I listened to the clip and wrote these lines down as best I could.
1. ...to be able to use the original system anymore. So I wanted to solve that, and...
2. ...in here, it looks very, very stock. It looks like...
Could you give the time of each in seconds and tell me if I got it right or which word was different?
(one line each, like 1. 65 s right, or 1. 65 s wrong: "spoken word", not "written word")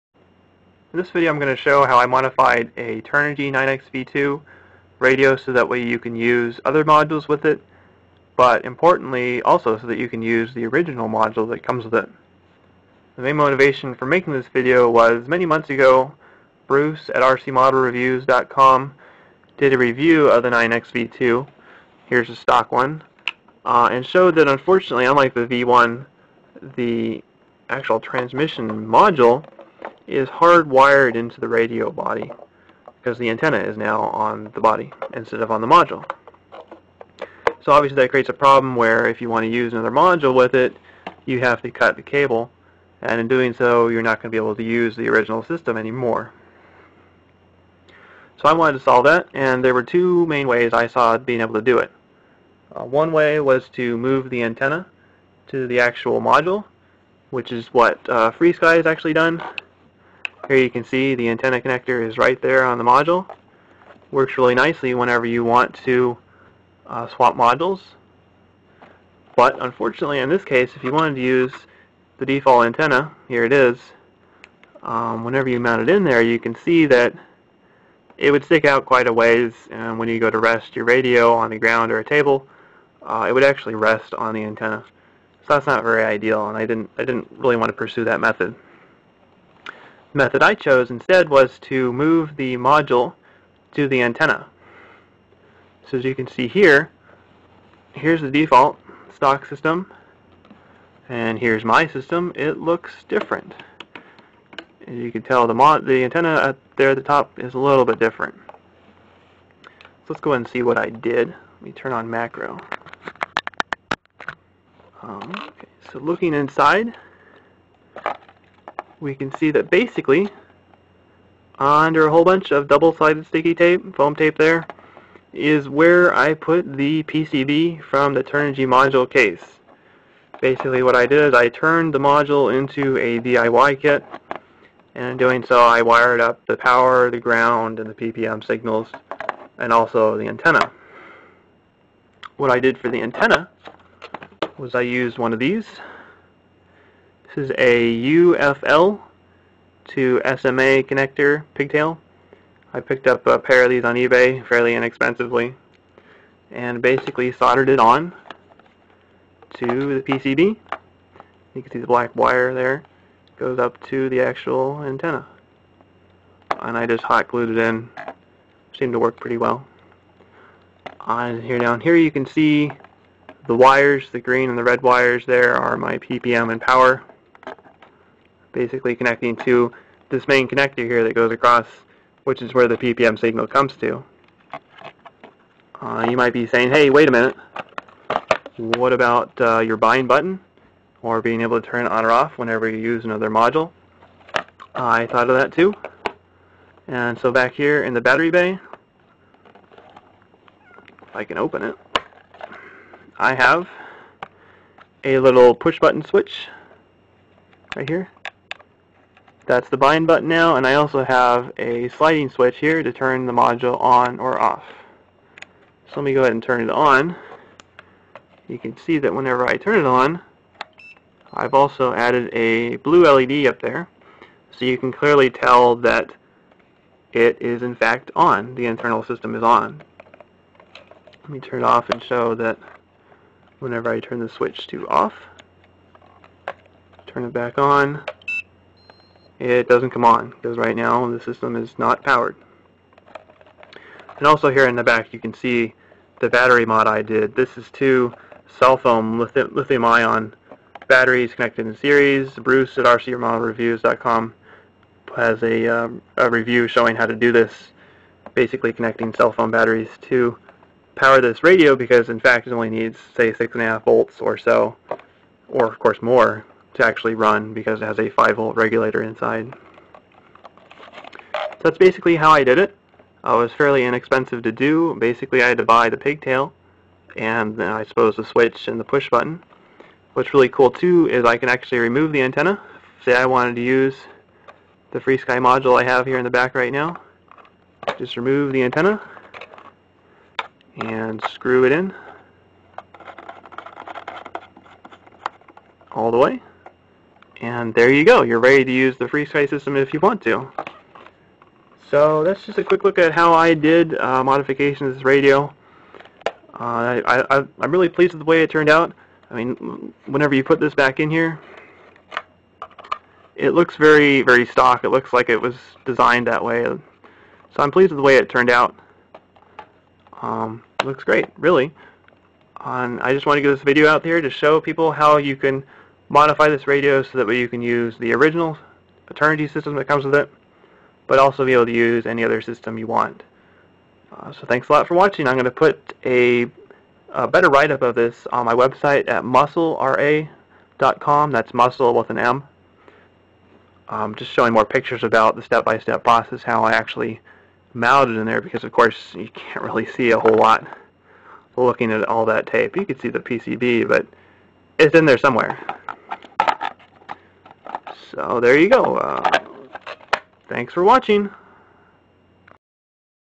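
1. 44 s right
2. 310 s right.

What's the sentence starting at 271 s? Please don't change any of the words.
So that's basically how I did it.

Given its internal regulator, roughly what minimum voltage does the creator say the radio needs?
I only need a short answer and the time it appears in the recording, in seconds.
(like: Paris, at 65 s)
6.5 volts, at 263 s.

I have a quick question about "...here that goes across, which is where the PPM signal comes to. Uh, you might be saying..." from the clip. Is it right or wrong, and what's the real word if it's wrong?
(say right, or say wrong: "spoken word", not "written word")
right.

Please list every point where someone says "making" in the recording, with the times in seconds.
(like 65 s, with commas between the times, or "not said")
14 s.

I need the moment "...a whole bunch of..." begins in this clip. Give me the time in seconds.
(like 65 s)
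122 s.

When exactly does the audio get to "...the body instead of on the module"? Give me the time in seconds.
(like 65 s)
34 s.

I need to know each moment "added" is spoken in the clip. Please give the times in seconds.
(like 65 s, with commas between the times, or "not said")
221 s.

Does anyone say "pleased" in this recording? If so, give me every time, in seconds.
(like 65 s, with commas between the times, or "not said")
307 s, 317 s.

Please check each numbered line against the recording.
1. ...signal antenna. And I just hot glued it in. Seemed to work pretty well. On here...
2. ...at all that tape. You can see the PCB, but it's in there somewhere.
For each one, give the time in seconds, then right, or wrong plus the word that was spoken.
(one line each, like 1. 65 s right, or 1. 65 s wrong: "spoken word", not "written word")
1. 164 s wrong: "actual", not "signal"
2. 351 s right.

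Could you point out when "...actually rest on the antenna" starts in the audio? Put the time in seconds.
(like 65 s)
83 s.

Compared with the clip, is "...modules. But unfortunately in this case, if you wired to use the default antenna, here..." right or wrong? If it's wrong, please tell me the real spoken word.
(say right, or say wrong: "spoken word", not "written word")
wrong: "wanted", not "wired".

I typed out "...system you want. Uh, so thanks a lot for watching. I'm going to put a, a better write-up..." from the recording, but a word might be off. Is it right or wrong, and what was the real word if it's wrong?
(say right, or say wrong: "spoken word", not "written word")
right.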